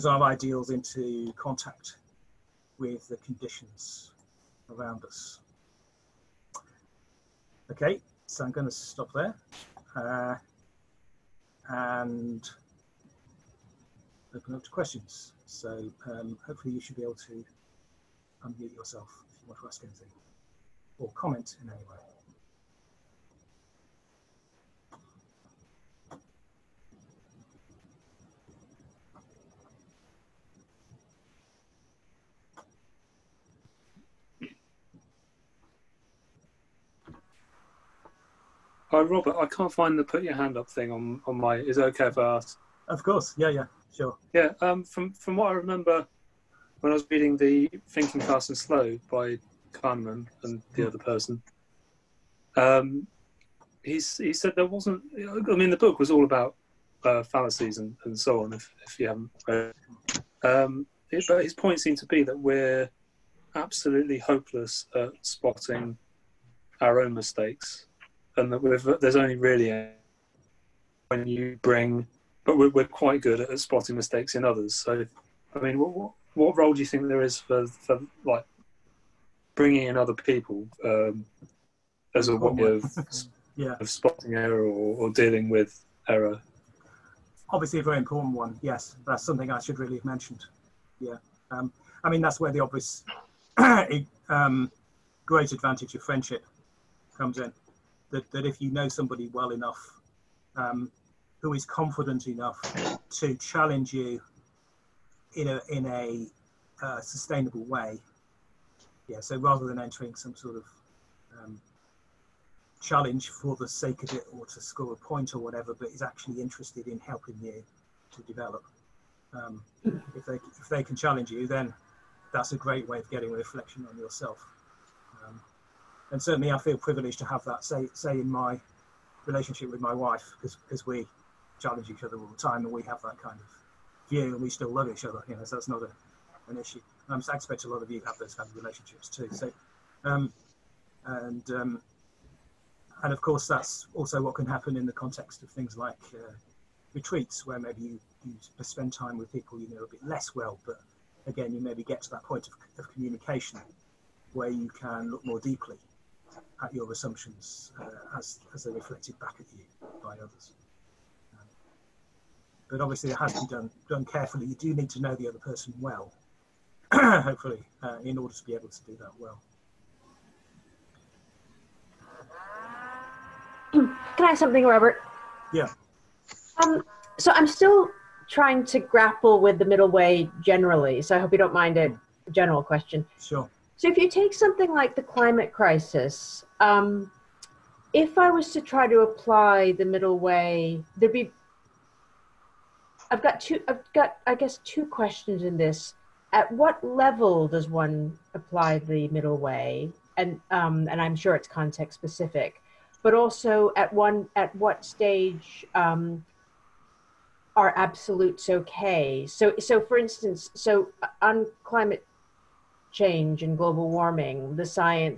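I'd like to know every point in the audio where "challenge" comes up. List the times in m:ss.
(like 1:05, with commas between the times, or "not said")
1:43, 1:52, 2:00, 2:11.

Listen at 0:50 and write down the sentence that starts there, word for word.
other person, um, he's, he said there wasn't.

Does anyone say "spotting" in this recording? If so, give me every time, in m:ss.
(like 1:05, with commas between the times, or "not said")
1:05, 1:13, 1:23.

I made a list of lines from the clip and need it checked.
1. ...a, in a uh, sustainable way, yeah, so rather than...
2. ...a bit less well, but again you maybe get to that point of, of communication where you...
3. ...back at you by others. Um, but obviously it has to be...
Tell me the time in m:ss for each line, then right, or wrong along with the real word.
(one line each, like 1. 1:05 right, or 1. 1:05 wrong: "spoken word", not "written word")
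1. 1:45 right
2. 2:29 right
3. 2:39 right.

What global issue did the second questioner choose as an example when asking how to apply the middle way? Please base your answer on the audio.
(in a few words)
The climate crisis.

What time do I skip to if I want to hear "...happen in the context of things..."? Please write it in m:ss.
2:24.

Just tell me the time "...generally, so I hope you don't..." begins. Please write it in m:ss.
3:00.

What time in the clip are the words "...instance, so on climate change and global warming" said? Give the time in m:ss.
3:29.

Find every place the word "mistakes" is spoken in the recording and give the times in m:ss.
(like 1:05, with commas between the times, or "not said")
1:07, 1:13.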